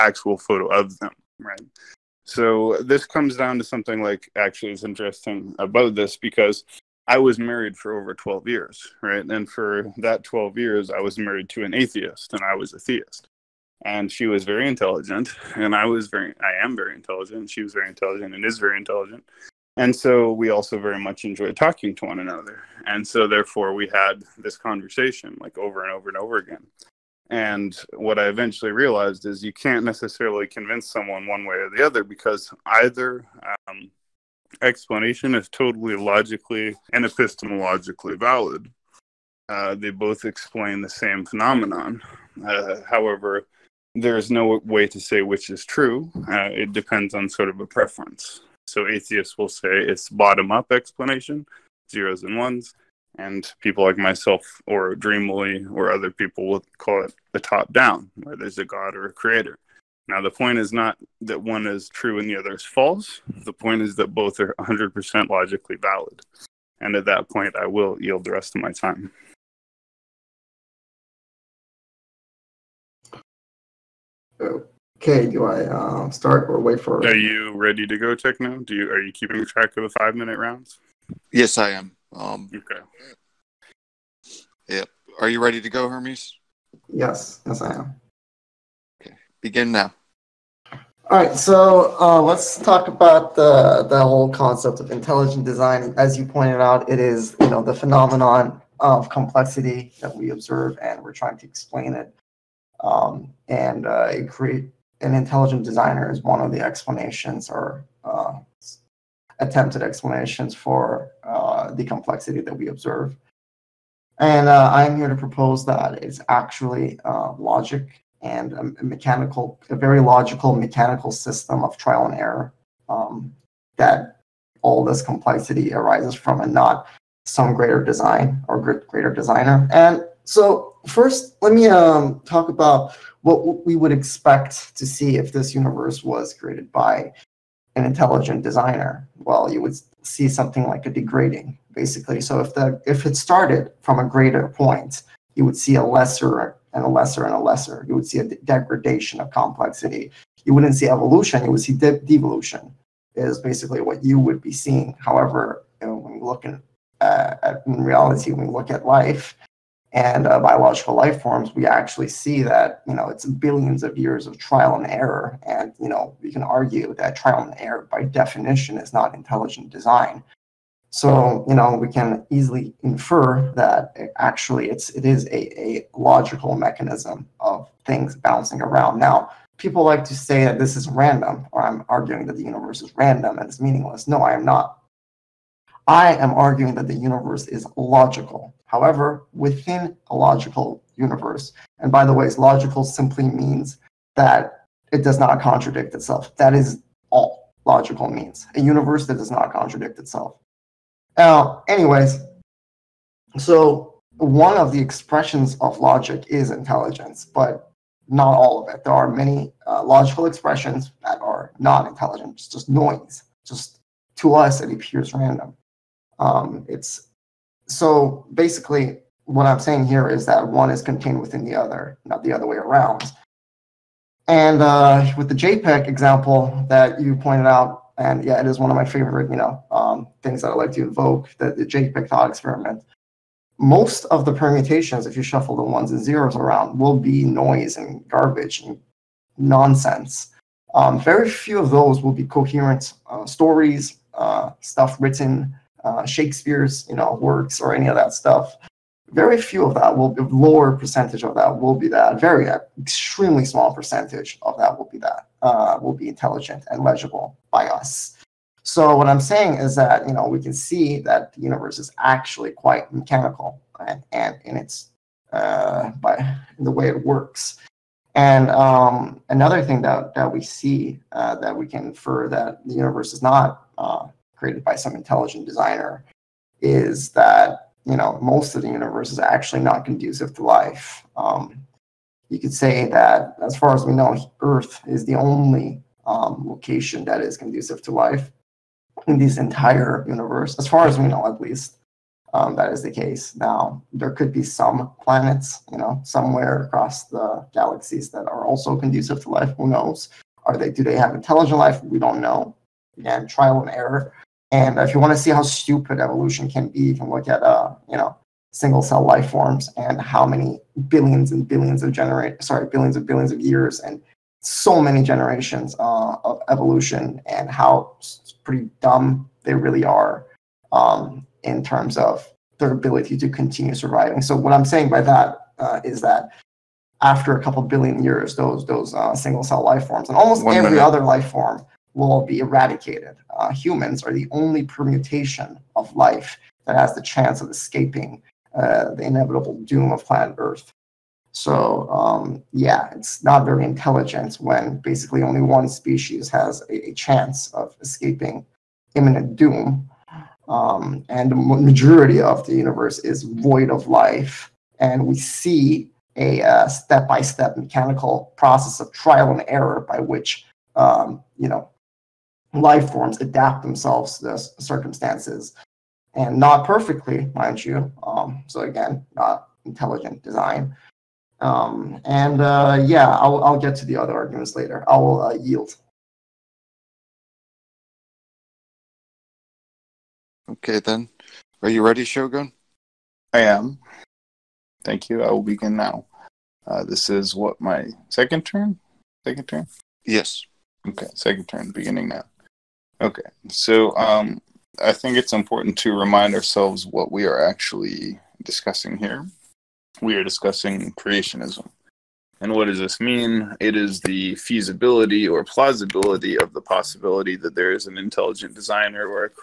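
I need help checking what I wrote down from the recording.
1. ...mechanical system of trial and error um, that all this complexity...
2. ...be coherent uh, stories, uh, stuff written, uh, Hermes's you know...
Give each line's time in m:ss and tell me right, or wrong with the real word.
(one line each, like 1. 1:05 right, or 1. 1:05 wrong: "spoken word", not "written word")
1. 2:00 right
2. 4:02 wrong: "Shakespeare", not "Hermes".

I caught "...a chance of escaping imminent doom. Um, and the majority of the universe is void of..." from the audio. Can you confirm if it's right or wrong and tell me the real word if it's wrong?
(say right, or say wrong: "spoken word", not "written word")
right.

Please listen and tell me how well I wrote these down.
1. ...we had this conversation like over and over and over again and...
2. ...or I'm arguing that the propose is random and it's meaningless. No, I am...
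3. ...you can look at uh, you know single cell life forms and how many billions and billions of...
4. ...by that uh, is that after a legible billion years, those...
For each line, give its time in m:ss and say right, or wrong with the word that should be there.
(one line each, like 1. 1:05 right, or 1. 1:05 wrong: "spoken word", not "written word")
1. 0:23 right
2. 3:01 wrong: "universe", not "propose"
3. 5:06 right
4. 5:24 wrong: "couple", not "legible".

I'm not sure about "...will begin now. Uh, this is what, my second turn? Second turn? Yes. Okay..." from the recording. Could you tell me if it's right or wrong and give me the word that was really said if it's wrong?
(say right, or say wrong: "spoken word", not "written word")
right.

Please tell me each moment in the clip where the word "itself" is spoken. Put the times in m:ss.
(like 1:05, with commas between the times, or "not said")
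3:15, 3:19.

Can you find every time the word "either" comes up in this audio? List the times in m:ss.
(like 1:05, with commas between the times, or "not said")
0:32.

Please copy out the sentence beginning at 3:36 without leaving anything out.
Um, it's so basically, what I'm saying here is that one is contained within the other, not the other way around.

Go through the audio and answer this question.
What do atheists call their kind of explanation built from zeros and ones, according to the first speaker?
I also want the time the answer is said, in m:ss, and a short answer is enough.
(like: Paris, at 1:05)
bottom up, at 0:50.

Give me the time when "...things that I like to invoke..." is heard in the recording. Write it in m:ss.
3:50.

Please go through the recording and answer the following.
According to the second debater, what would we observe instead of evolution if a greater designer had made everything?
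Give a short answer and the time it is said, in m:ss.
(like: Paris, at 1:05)
devolution, at 2:31.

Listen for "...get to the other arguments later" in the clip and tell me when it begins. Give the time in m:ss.
6:13.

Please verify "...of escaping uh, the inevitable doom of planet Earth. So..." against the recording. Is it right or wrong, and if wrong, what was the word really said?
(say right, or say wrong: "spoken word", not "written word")
right.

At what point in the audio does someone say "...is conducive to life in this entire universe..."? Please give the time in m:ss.
4:47.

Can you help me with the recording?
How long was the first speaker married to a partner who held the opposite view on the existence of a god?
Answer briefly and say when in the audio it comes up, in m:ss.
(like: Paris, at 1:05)
over 12 years, at 0:07.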